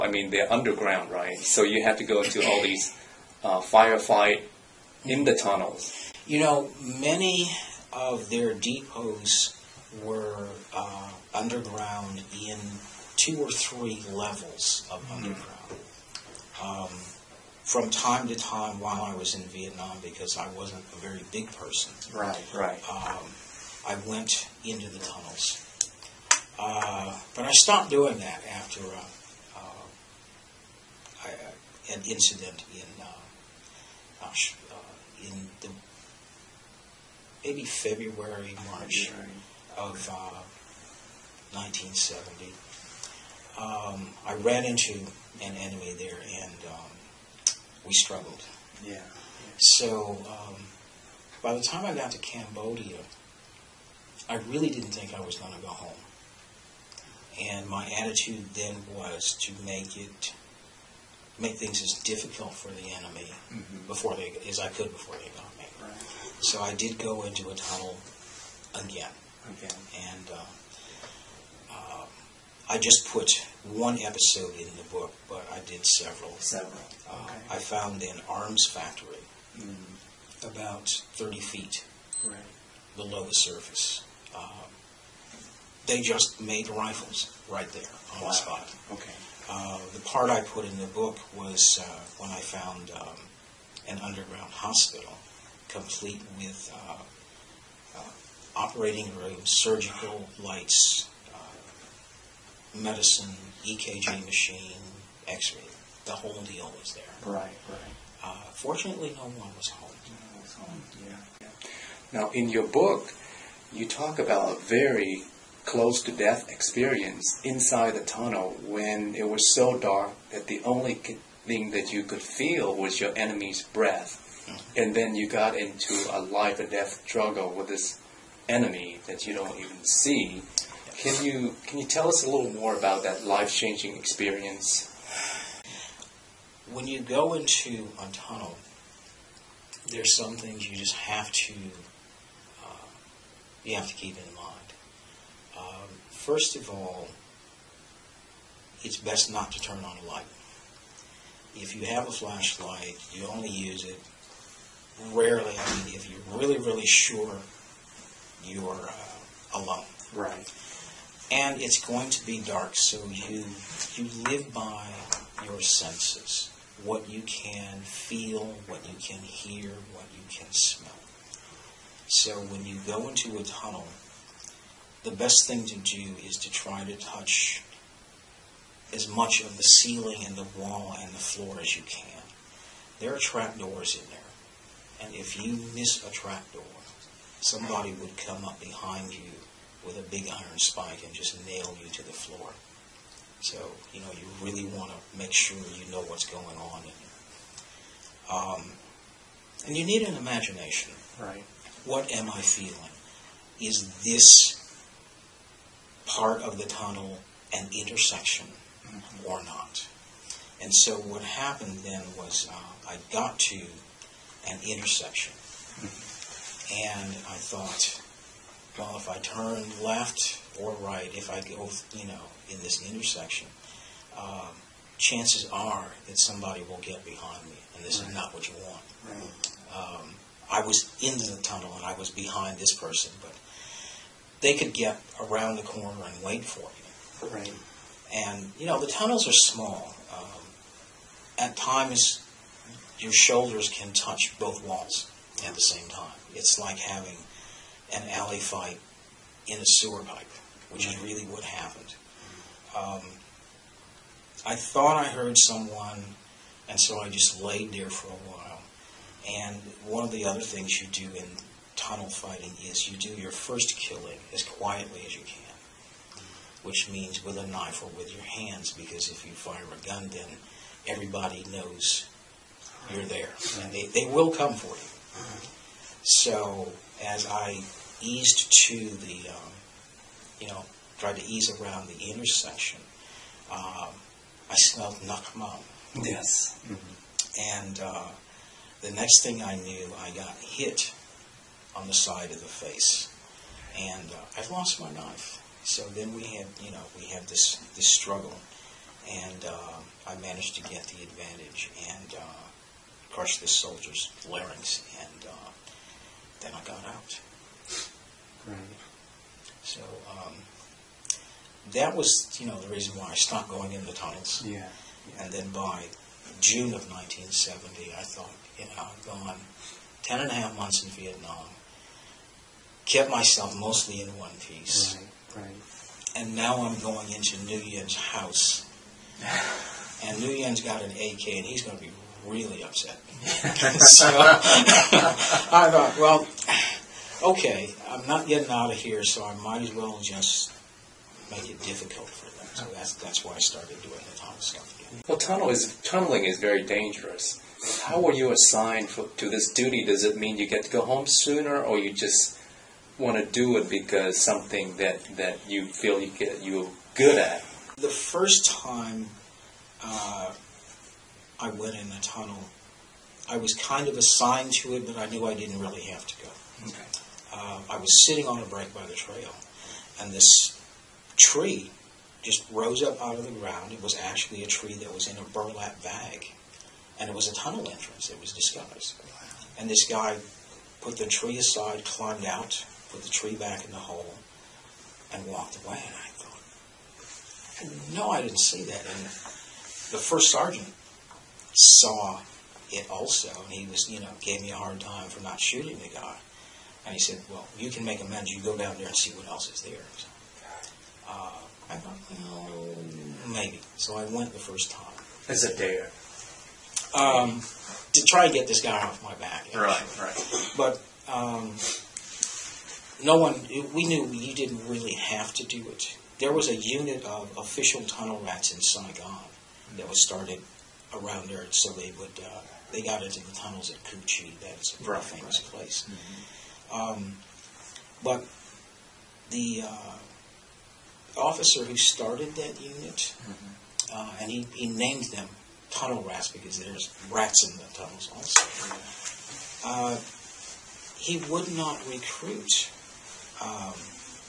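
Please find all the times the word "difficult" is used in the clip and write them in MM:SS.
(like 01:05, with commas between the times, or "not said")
01:02, 05:41.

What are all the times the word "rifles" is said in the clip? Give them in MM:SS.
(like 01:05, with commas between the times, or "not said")
01:26.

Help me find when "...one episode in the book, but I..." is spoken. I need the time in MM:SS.
01:13.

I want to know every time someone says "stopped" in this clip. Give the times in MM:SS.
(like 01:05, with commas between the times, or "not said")
00:27, 05:13.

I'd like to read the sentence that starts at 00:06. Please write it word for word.
You know, many of their depots were uh, underground in two or three levels of mm underground.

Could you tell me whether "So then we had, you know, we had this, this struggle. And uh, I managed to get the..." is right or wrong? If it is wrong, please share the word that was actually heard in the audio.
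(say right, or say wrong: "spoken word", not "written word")
right.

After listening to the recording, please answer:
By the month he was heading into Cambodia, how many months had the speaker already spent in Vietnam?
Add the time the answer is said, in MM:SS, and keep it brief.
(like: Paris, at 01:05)
10 and a half months, at 05:20.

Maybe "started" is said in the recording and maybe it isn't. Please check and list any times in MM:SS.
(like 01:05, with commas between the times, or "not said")
05:43, 07:00, 07:11.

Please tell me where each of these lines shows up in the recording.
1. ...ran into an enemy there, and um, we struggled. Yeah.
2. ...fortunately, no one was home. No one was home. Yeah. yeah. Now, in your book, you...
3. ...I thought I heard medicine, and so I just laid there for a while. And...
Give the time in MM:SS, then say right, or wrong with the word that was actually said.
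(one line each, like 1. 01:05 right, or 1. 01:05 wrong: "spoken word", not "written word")
1. 00:44 right
2. 01:48 right
3. 04:14 wrong: "someone", not "medicine".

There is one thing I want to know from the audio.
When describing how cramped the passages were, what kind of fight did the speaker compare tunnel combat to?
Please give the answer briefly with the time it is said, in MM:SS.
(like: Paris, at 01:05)
An alley fight in a sewer pipe, at 04:08.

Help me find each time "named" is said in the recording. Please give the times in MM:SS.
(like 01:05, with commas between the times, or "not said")
07:14.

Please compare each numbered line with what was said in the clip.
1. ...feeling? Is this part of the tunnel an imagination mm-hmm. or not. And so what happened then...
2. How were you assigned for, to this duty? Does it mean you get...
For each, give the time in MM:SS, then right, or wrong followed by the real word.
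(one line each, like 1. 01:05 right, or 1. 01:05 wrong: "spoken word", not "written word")
1. 03:22 wrong: "intersection", not "imagination"
2. 05:47 right.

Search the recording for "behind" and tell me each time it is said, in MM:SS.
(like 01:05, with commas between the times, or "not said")
03:08, 03:47, 03:52.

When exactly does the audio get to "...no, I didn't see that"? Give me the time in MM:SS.
06:27.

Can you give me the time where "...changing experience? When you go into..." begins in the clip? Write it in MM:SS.
02:13.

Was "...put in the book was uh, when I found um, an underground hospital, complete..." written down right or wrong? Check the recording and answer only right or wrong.
right.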